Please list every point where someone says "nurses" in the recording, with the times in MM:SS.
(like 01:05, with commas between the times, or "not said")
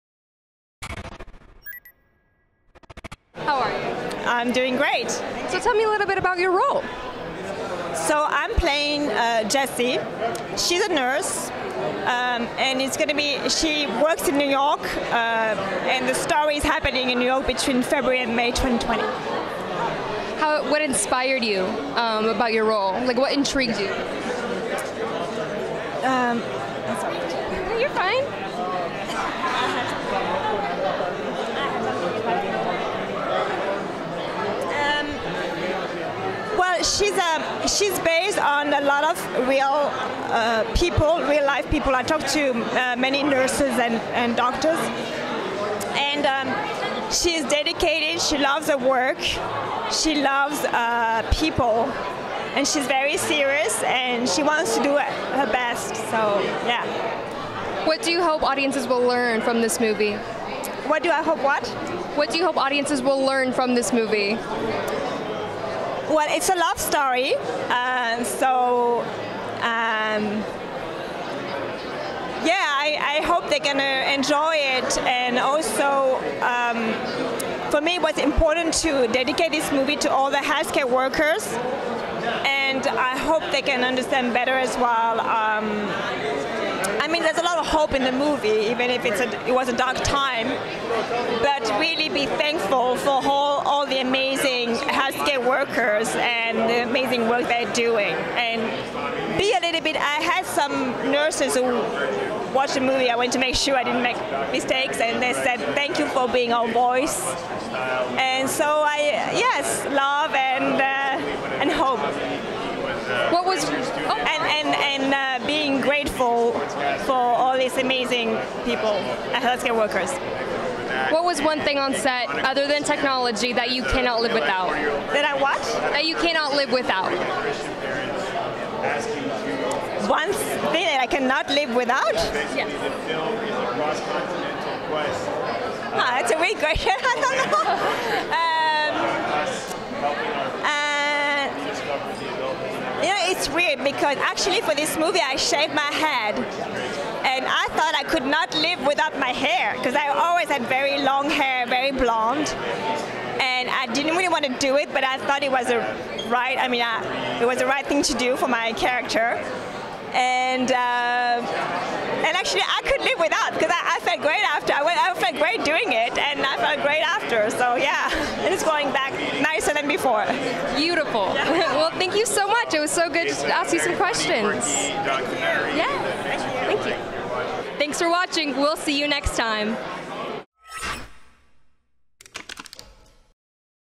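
00:10, 00:43, 01:41.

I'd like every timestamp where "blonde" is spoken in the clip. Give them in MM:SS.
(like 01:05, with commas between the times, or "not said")
02:31.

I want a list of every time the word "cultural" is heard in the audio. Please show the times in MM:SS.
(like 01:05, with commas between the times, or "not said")
not said.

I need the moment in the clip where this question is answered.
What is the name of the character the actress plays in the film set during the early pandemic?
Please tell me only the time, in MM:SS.
00:09.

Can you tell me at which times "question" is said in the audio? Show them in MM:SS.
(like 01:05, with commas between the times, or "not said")
02:16, 02:53.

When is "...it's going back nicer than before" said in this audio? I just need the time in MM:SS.
02:48.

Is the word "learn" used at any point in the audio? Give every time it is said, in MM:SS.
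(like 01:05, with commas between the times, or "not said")
00:59, 01:03.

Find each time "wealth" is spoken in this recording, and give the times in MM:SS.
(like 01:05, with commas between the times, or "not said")
not said.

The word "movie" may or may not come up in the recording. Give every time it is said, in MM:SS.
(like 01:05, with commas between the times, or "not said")
00:59, 01:03, 01:19, 01:28, 01:42, 02:24.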